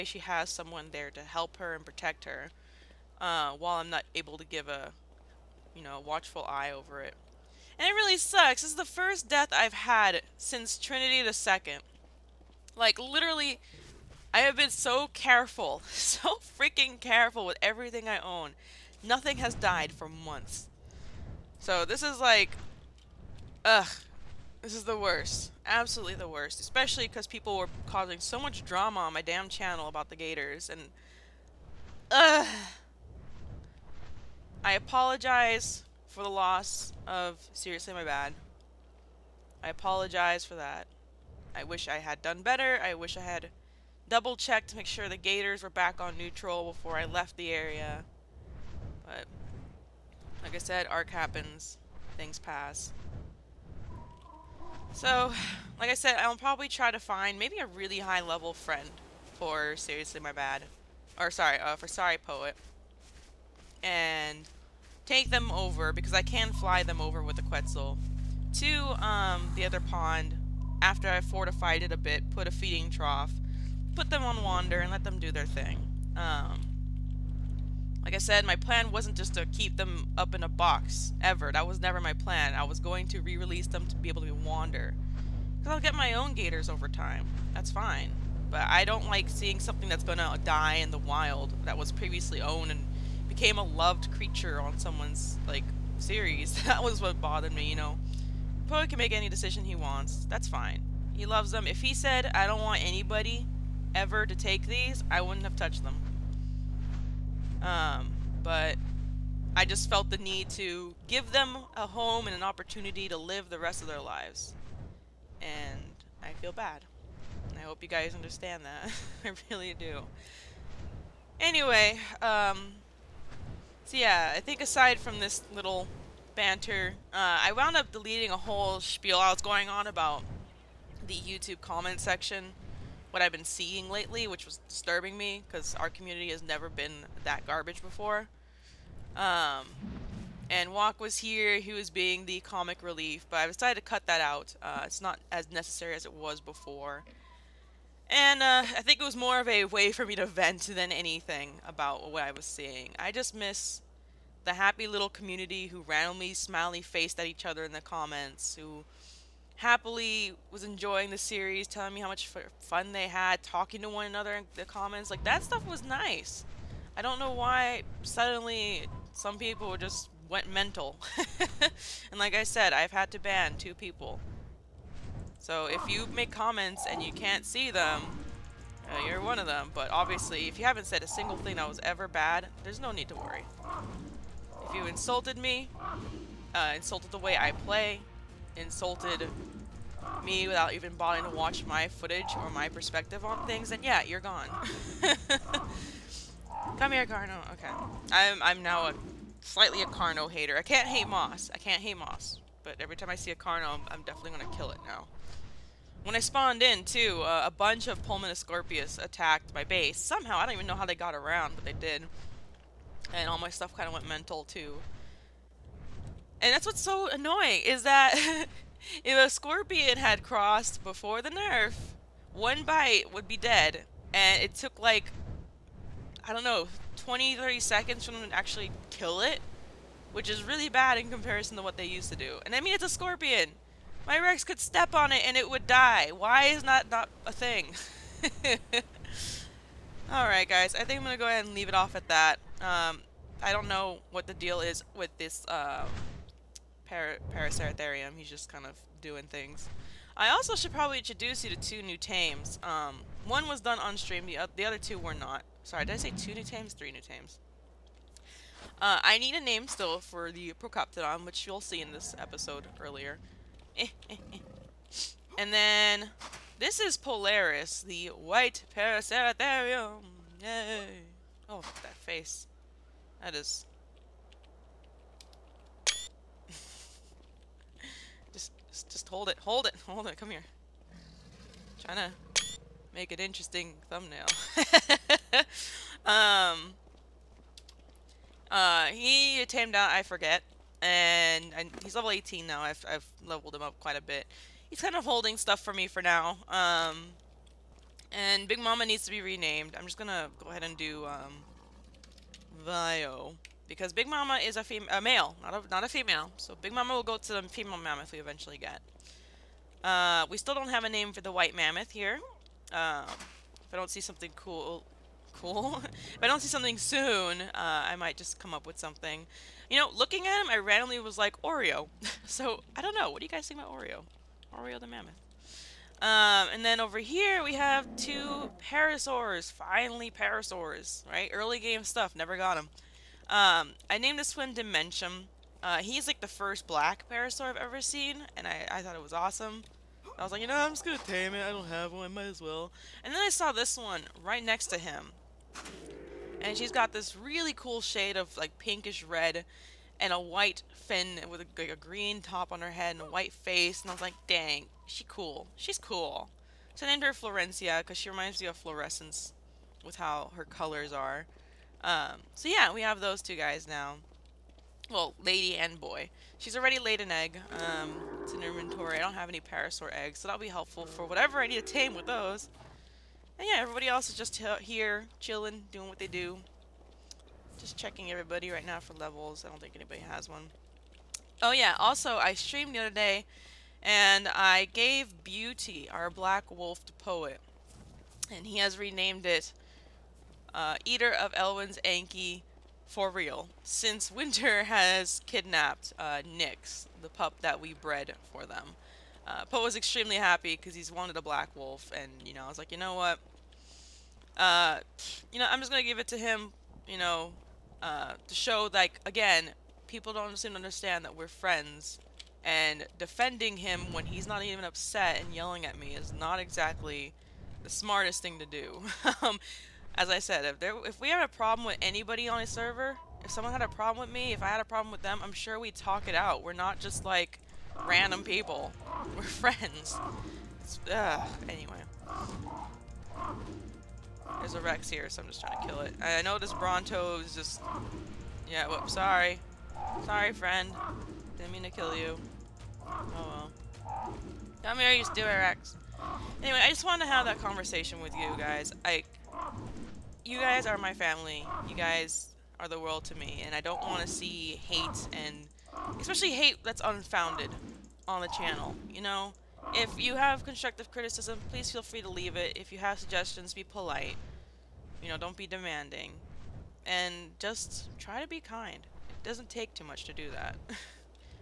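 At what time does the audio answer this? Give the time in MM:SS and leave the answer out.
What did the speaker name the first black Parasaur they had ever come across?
05:34.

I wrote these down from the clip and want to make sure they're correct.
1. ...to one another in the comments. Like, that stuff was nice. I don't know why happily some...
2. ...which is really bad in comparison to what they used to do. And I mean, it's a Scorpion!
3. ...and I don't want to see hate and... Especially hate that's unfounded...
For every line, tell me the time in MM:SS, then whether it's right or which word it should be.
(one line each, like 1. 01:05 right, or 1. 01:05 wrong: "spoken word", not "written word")
1. 02:43 wrong: "suddenly", not "happily"
2. 03:50 right
3. 07:33 right.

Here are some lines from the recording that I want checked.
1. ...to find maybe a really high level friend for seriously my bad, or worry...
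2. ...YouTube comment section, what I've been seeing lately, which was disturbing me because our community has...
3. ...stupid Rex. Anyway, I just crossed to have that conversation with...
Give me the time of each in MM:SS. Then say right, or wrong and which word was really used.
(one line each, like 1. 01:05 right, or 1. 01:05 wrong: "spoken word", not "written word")
1. 00:56 wrong: "sorry", not "worry"
2. 02:11 right
3. 07:25 wrong: "wanted", not "crossed".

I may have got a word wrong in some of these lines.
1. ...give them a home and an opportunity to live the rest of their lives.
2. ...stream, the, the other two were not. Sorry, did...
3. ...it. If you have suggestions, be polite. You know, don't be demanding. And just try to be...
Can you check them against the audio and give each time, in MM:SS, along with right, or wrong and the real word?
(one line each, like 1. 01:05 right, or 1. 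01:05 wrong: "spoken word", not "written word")
1. 01:51 right
2. 04:13 right
3. 07:42 right.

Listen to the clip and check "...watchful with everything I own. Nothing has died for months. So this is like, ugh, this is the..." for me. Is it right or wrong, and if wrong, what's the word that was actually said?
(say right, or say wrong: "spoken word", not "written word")
wrong: "careful", not "watchful".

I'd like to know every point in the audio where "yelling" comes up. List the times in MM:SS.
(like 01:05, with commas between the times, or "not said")
06:55.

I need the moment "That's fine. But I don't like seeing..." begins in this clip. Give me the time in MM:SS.
01:27.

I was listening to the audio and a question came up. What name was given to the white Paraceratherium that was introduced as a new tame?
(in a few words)
Polaris.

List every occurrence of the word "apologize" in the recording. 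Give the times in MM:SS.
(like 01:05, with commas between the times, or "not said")
00:34, 00:39.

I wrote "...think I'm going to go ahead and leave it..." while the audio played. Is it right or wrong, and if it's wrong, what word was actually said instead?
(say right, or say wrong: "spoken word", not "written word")
right.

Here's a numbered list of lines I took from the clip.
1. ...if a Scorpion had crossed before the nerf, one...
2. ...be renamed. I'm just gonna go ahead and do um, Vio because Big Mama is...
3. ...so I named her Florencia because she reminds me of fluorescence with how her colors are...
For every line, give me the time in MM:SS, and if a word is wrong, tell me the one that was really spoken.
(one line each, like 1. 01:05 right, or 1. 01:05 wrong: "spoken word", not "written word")
1. 03:39 right
2. 04:59 right
3. 05:56 right.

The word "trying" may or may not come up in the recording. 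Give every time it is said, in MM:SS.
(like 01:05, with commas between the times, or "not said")
04:41, 07:15.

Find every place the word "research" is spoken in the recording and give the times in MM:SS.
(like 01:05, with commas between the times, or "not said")
not said.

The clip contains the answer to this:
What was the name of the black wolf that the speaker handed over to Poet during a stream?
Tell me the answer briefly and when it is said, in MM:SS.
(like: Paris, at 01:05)
Beauty, at 06:25.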